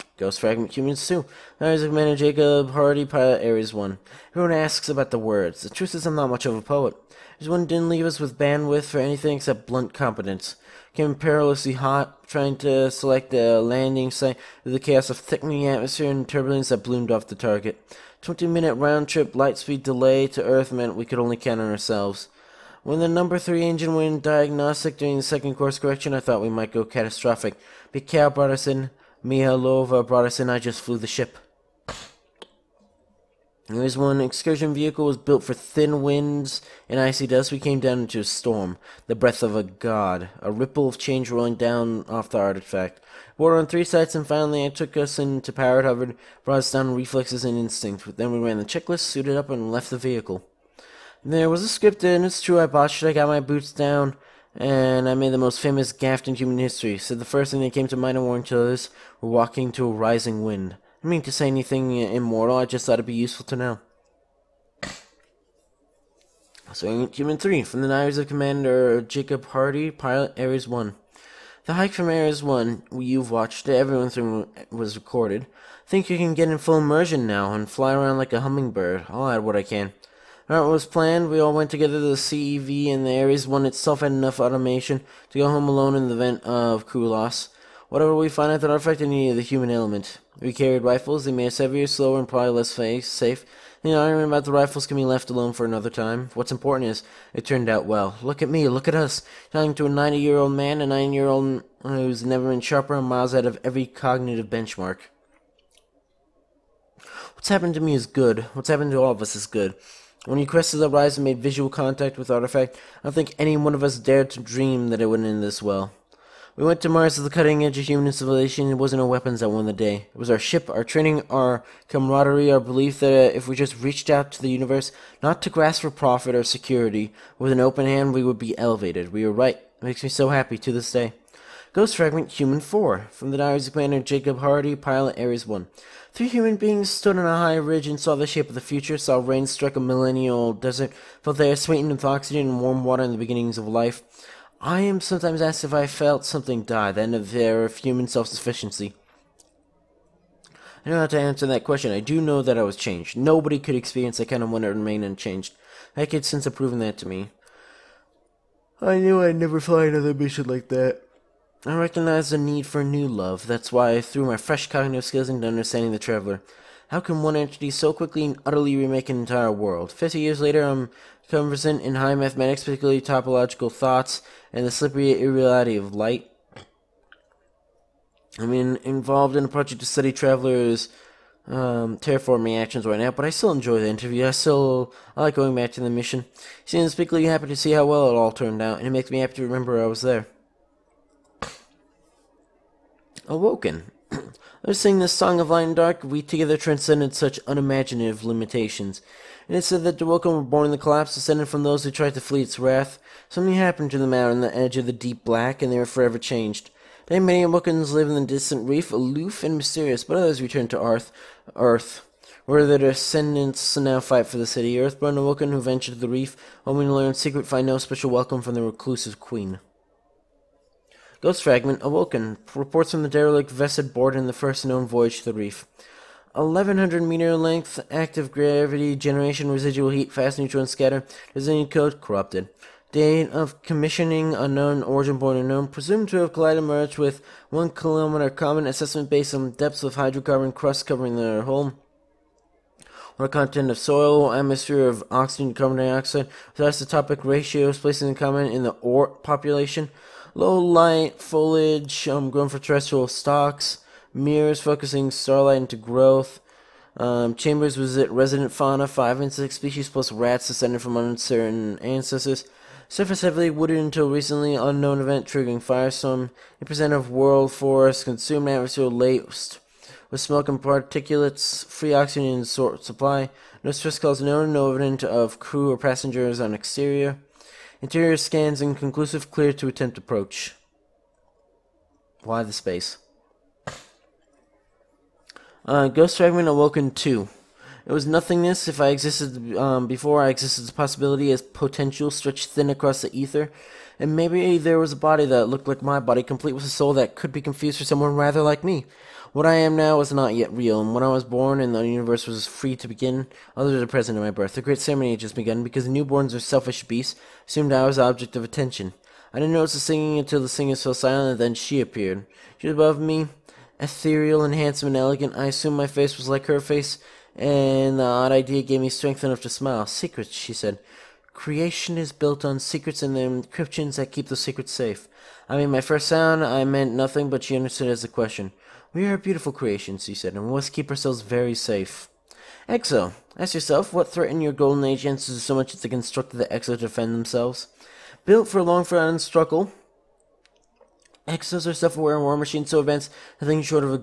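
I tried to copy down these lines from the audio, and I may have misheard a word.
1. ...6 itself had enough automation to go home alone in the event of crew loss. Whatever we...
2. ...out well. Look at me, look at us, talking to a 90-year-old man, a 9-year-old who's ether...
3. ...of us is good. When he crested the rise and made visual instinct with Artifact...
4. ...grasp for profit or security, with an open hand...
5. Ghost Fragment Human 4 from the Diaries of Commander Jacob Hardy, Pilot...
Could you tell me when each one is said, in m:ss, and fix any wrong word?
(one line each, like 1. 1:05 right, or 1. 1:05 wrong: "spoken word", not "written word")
1. 1:23 wrong: "1", not "6"
2. 1:37 wrong: "never", not "ether"
3. 1:49 wrong: "contact", not "instinct"
4. 2:05 right
5. 2:11 right.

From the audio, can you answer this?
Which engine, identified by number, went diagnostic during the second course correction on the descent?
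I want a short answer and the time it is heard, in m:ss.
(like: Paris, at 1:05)
Number 3, at 0:23.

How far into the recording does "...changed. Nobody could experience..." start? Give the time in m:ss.
2:32.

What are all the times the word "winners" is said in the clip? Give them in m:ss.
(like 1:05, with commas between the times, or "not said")
not said.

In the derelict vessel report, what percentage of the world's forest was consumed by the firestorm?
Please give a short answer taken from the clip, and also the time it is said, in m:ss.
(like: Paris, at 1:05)
8%, at 4:26.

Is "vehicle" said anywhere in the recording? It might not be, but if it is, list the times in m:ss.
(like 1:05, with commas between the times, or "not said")
0:34, 0:49.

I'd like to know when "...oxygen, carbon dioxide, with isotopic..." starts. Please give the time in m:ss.
4:05.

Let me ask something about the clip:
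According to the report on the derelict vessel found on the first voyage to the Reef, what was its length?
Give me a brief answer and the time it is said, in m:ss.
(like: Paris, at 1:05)
1100 meters, at 3:46.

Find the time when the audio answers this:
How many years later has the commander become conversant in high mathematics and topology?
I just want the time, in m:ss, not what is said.
2:49.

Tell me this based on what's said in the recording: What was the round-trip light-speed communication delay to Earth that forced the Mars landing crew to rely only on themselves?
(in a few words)
20 minute.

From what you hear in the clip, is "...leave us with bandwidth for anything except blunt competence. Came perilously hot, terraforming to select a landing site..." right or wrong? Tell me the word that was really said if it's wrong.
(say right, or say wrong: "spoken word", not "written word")
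wrong: "trying", not "terraforming".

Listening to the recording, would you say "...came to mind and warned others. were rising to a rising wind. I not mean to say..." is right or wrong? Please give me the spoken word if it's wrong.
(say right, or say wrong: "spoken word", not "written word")
wrong: "walking", not "rising".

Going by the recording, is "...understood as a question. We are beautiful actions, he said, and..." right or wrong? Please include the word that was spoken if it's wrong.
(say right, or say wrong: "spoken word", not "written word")
wrong: "creations", not "actions".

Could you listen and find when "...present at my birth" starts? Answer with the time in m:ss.
5:03.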